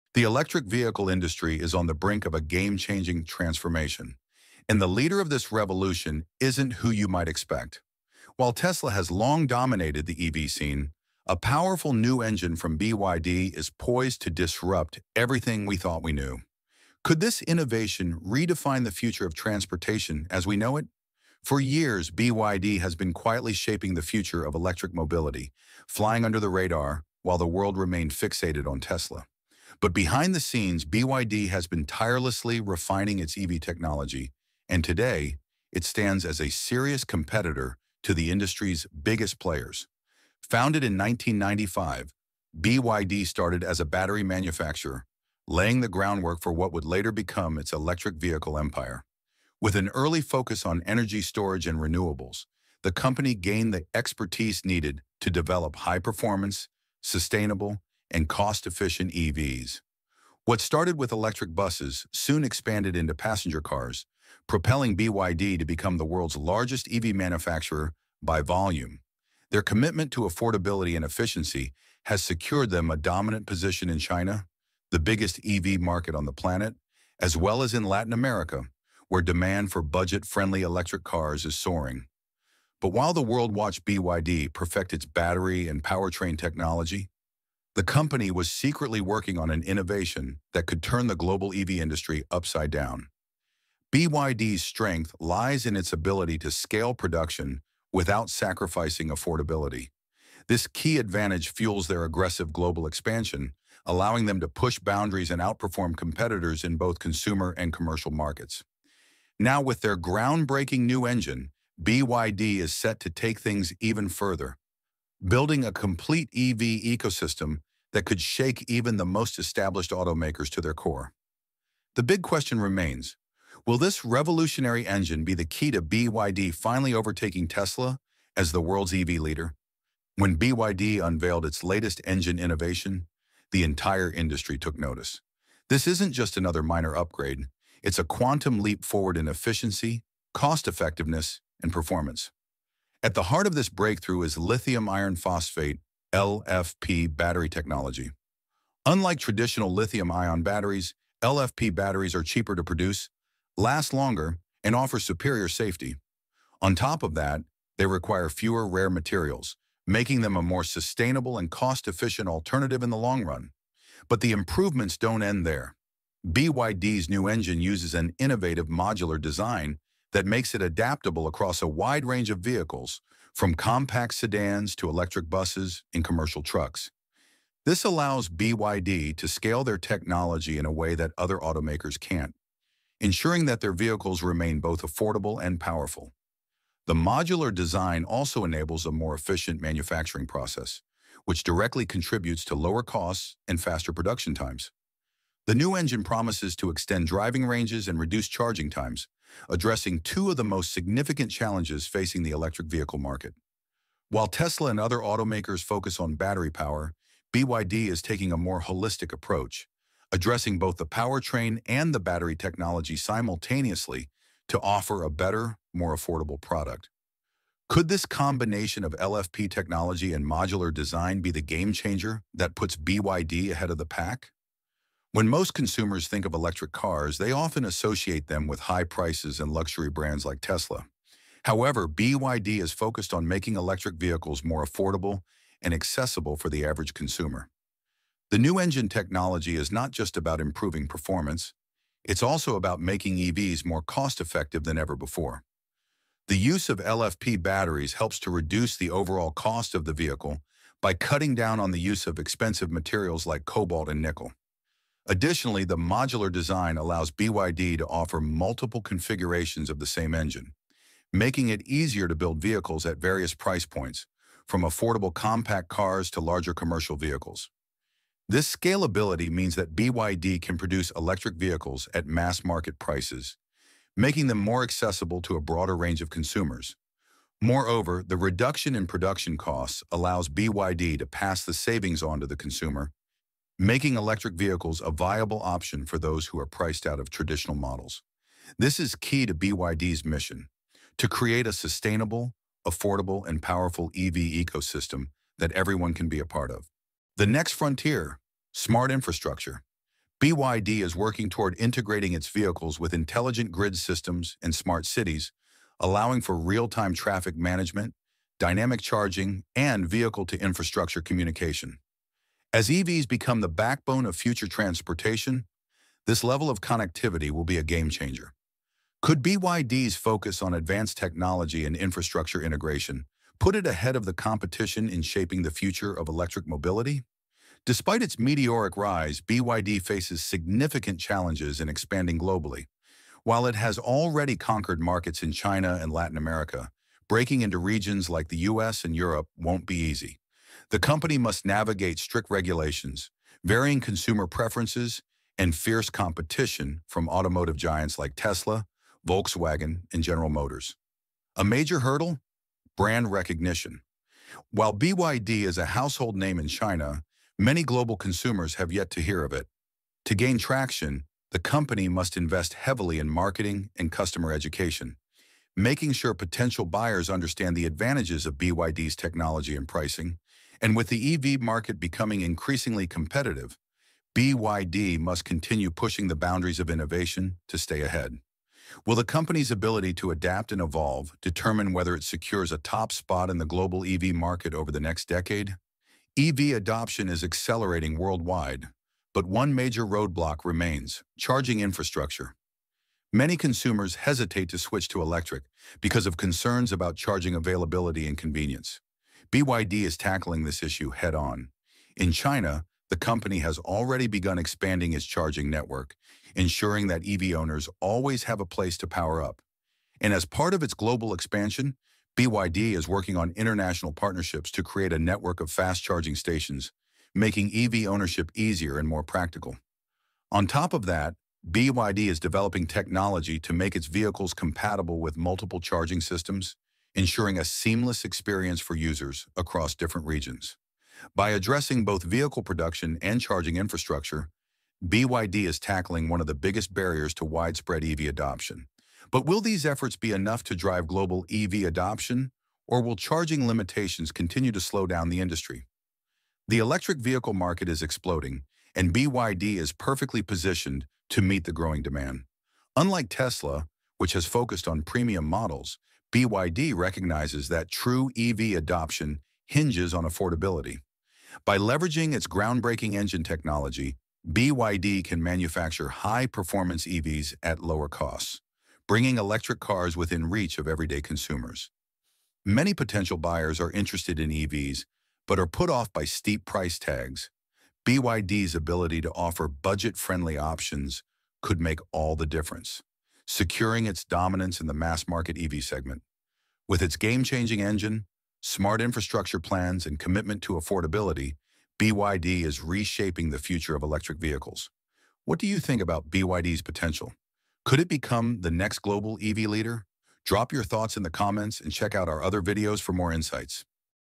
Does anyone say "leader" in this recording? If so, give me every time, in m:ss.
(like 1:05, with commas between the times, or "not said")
0:04, 2:09, 8:19.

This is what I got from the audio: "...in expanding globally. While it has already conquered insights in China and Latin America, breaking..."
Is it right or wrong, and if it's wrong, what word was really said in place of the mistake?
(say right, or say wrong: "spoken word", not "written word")
wrong: "markets", not "insights".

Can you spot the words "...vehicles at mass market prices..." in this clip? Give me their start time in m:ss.
4:31.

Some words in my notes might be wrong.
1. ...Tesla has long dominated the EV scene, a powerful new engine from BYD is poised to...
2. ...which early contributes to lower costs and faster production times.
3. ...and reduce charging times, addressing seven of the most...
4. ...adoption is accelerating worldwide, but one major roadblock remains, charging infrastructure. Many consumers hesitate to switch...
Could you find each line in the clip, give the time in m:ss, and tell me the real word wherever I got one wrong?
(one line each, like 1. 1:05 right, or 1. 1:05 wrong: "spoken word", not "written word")
1. 0:08 right
2. 3:11 wrong: "directly", not "early"
3. 3:17 wrong: "two", not "seven"
4. 6:26 right.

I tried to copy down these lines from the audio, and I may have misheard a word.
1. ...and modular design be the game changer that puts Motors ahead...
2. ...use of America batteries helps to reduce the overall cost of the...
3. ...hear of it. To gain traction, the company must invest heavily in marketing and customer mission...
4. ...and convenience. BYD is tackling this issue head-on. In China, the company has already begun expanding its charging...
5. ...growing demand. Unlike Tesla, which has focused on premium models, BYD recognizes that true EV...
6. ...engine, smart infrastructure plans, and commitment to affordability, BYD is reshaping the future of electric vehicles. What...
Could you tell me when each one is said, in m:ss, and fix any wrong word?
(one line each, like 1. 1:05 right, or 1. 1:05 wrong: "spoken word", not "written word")
1. 3:40 wrong: "BYD", not "Motors"
2. 4:06 wrong: "LFP", not "America"
3. 5:59 wrong: "education", not "mission"
4. 6:38 right
5. 7:31 right
6. 8:07 right.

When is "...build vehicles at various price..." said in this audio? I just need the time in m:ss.
4:22.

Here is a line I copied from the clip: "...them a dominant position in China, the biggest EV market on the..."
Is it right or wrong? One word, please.
right.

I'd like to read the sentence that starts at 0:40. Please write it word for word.
Founded in 1995, BYD started as a battery manufacturer, laying the groundwork for what would later become its electric vehicle empire.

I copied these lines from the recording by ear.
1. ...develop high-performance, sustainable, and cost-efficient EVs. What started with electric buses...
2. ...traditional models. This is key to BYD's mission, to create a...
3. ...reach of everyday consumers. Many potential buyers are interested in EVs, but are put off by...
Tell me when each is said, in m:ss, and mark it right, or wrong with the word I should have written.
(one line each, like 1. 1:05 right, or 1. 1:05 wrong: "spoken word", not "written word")
1. 0:55 right
2. 4:47 right
3. 7:50 right.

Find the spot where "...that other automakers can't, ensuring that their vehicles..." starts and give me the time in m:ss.
3:00.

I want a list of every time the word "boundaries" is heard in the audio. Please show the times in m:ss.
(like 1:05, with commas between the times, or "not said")
1:44, 6:16.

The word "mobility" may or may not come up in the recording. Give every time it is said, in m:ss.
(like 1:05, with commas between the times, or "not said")
0:24, 5:26.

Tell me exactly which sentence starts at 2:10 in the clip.
When BYD unveiled its latest engine innovation, the entire industry took notice.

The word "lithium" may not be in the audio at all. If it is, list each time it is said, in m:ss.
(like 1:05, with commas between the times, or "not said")
2:24, 2:29.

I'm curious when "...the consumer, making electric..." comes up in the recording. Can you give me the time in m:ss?
4:42.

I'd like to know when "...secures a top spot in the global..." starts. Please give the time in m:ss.
6:22.